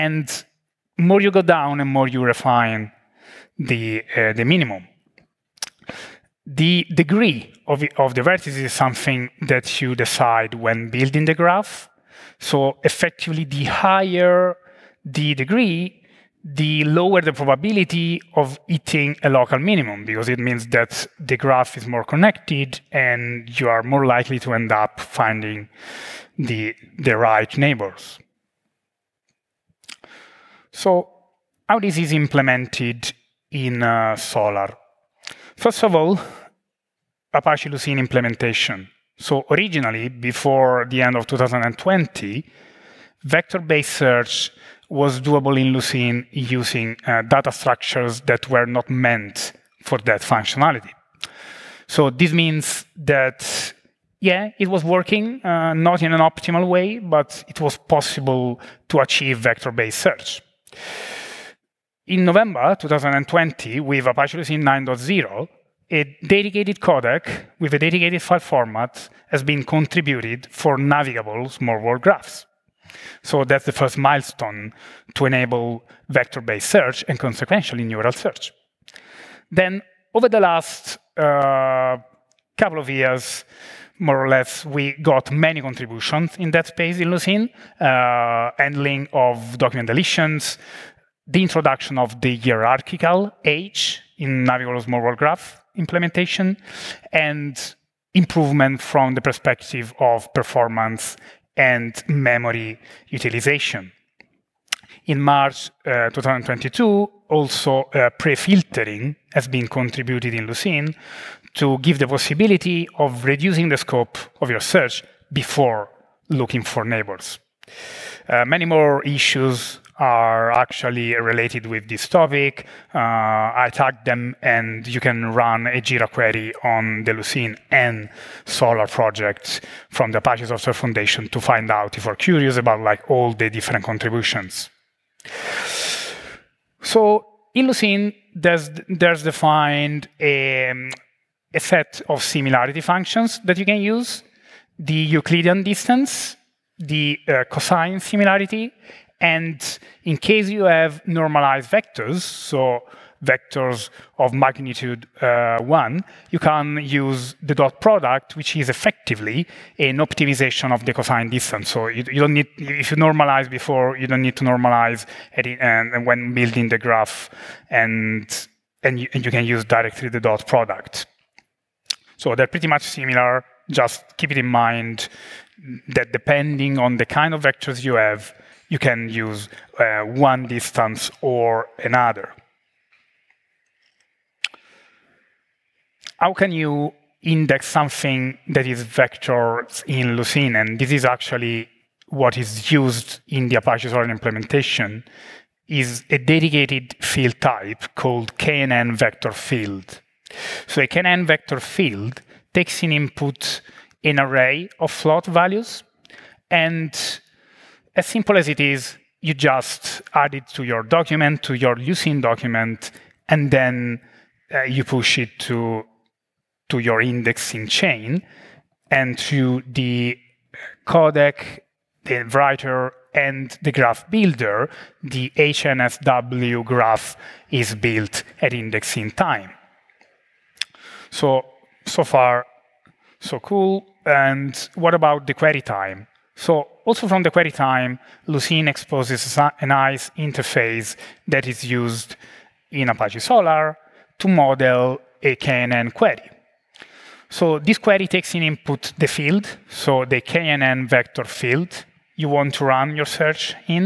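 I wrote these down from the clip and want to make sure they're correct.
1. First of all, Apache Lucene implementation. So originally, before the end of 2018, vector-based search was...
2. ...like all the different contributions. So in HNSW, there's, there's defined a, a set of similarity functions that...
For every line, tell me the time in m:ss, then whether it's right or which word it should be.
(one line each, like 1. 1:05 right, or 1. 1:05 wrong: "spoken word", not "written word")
1. 0:35 wrong: "2020", not "2018"
2. 2:12 wrong: "Lucene", not "HNSW".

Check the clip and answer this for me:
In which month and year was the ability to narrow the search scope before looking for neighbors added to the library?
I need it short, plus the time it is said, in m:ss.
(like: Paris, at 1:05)
March 2022, at 1:45.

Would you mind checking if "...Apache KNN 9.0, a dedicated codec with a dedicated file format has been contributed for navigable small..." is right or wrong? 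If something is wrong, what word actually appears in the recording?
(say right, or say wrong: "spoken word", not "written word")
wrong: "Lucene", not "KNN".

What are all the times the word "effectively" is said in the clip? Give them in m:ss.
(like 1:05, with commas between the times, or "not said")
0:12, 2:38.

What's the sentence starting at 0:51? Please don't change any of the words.
So this means that, yeah, it was working, uh, not in an optimal way, but it was possible to achieve vector-based search.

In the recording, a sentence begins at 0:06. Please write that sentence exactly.
The degree of, the, of the vertices is something that you decide when building the graph.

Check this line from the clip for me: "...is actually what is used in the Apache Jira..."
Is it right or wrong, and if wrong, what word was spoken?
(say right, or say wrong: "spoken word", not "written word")
wrong: "Solr", not "Jira".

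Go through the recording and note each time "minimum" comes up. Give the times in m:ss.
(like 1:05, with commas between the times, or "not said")
0:04, 0:19.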